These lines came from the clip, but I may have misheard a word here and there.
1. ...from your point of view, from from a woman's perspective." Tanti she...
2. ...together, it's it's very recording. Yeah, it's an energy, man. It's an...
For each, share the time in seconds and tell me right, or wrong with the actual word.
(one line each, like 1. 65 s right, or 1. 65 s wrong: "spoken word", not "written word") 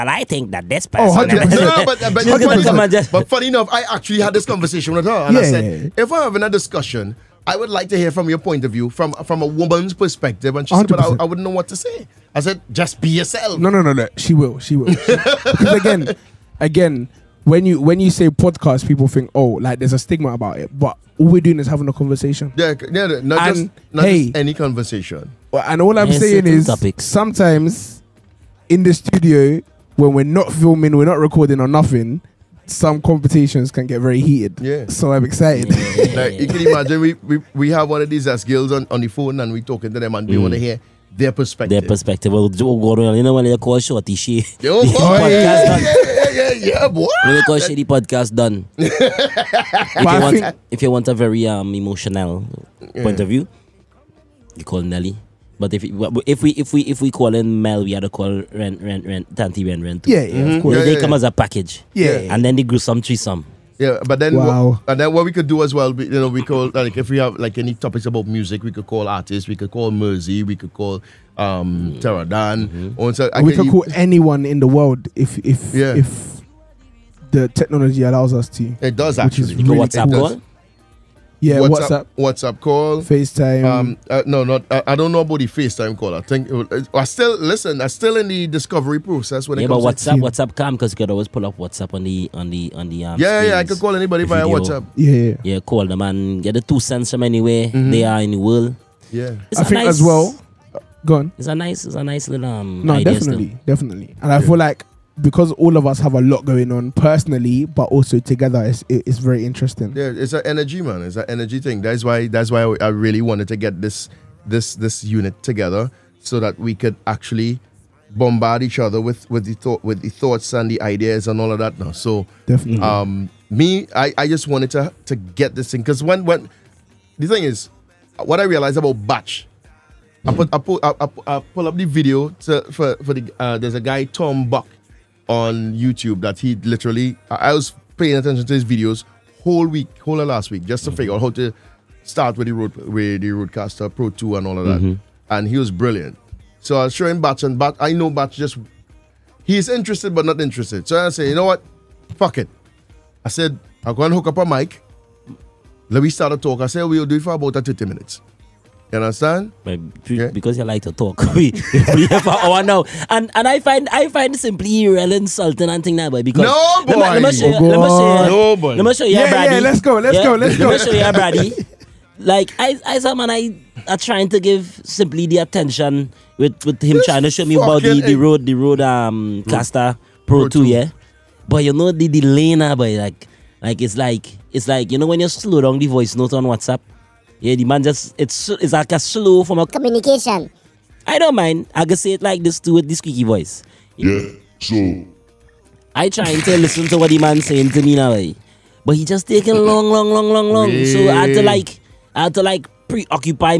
1. 8 s wrong: "And", not "Tanti"
2. 108 s wrong: "interesting", not "recording".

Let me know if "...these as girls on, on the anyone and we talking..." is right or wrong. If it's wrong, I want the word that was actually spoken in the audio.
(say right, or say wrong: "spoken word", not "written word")
wrong: "phone", not "anyone".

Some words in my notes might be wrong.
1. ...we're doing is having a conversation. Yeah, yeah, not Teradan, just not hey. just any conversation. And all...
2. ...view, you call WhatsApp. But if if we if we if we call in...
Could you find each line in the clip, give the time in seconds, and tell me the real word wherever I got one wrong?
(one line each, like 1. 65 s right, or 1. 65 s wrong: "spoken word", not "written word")
1. 21 s wrong: "And", not "Teradan"
2. 53 s wrong: "Nelly", not "WhatsApp".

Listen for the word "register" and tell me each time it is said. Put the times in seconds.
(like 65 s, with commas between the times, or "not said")
not said.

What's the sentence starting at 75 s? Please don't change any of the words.
if the technology allows us to.